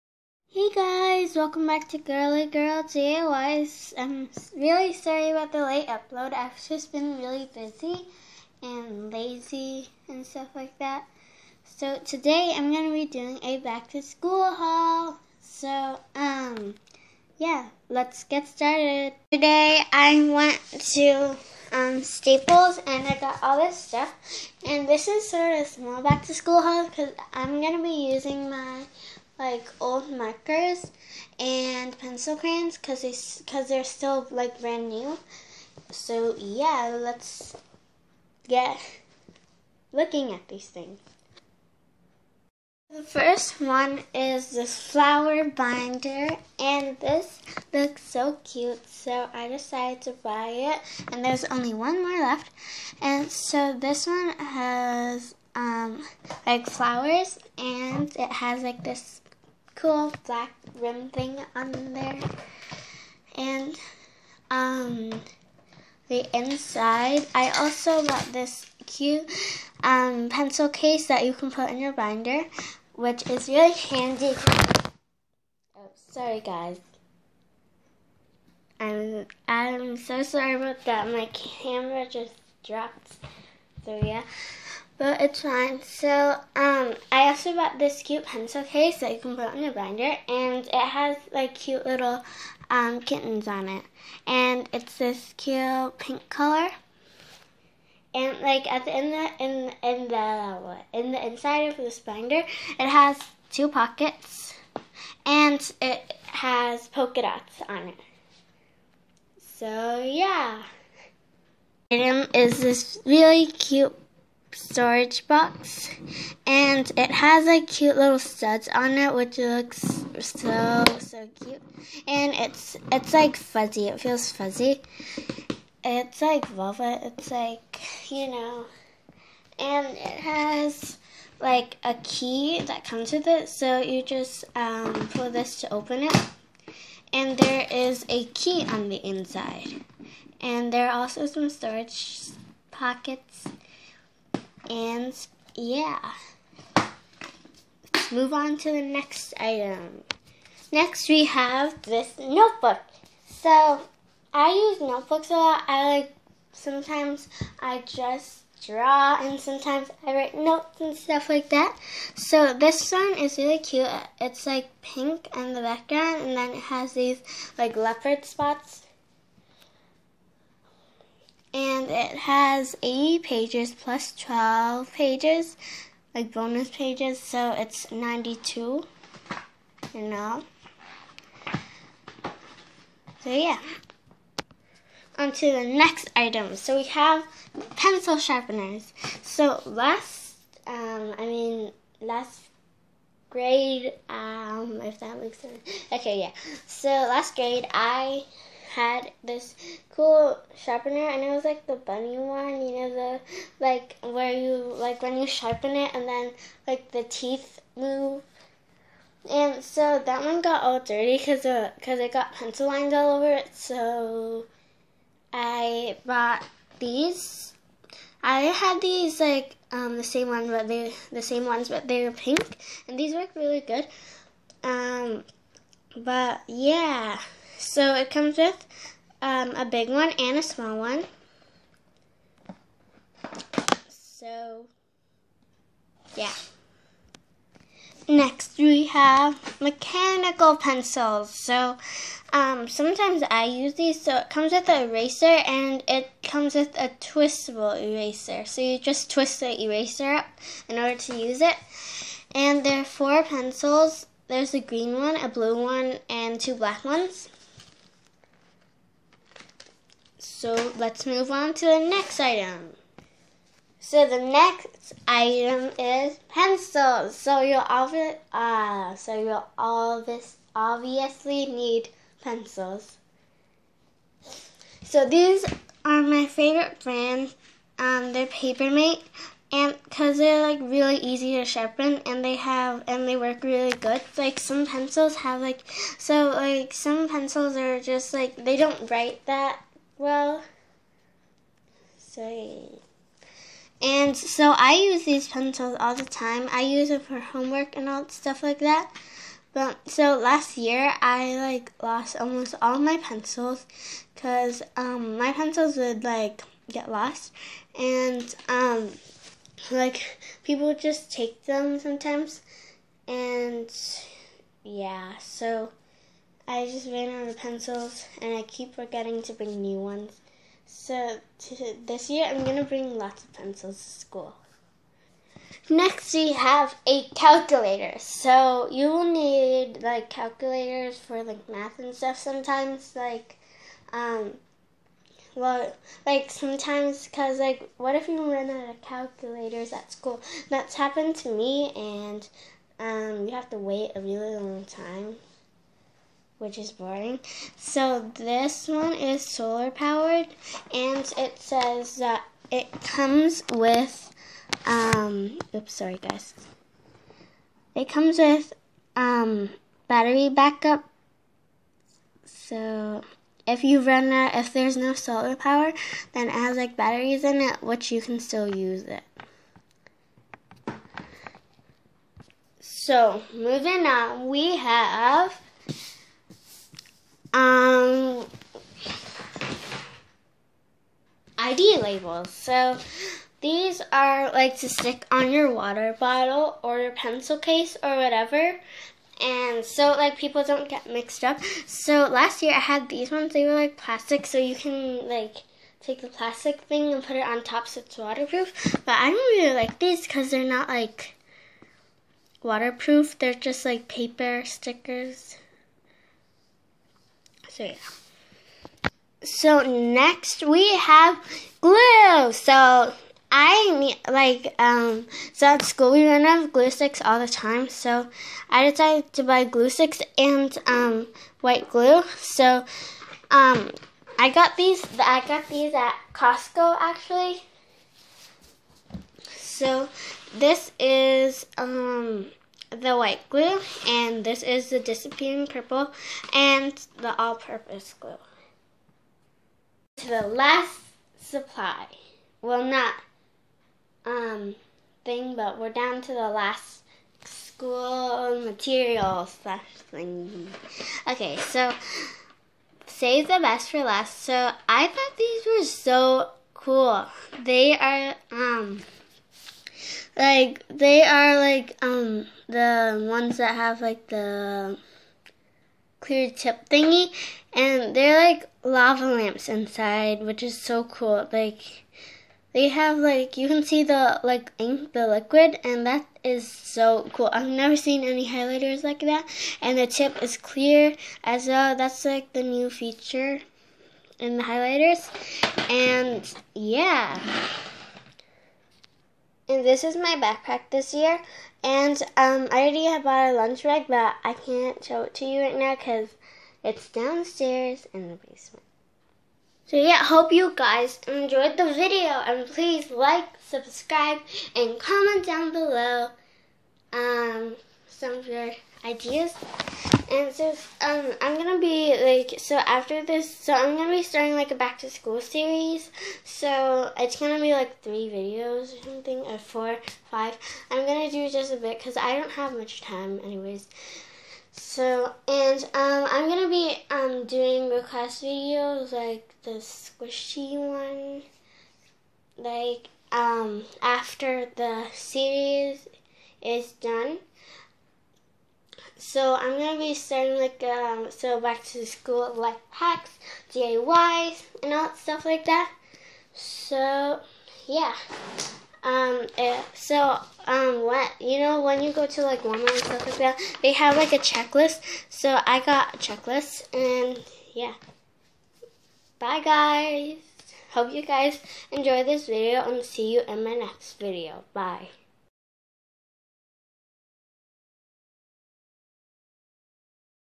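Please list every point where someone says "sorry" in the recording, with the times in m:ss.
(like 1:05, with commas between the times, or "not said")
0:04, 1:16, 1:20, 4:51, 5:55.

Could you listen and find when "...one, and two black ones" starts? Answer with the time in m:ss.
4:15.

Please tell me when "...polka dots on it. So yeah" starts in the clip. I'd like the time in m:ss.
1:46.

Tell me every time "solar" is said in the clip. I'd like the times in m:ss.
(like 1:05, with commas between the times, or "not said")
5:49, 6:04.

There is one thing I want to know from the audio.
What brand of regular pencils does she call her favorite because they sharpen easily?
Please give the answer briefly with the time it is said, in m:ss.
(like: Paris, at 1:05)
Papermate, at 4:38.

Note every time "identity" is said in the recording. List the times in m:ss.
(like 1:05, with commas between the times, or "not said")
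not said.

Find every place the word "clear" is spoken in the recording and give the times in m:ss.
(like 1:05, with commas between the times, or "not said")
7:45, 8:00.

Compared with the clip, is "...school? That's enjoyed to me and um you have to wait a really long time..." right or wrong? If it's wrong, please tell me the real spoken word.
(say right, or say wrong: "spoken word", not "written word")
wrong: "happened", not "enjoyed".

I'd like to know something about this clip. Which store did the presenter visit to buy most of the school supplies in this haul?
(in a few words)
Staples.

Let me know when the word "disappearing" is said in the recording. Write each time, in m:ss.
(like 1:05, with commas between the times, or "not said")
7:14.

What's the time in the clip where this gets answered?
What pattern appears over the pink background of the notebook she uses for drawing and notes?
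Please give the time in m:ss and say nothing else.
2:47.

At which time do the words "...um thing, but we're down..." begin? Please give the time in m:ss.
7:24.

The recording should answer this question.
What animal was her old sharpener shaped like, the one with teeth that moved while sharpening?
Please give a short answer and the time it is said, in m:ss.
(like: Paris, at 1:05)
Bunny, at 3:21.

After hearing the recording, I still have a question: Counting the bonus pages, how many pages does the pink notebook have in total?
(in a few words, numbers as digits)
92.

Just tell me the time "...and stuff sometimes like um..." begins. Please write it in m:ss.
5:31.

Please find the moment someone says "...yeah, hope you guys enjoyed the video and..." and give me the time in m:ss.
8:19.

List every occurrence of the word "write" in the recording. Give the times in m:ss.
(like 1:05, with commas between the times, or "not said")
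2:40, 4:48.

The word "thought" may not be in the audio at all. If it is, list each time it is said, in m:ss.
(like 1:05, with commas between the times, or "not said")
7:34.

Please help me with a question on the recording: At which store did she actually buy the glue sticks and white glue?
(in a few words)
Costco.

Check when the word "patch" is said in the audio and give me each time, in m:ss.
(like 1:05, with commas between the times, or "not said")
not said.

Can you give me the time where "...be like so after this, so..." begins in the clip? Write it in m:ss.
8:31.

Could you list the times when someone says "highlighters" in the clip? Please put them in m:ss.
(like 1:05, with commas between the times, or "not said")
7:58, 8:04.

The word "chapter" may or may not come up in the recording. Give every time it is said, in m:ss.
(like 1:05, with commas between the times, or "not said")
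not said.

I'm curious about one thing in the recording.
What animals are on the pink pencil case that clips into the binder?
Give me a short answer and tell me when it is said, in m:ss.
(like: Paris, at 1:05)
Kittens, at 1:32.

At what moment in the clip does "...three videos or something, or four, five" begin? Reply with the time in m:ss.
8:37.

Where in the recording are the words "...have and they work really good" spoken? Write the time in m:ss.
4:42.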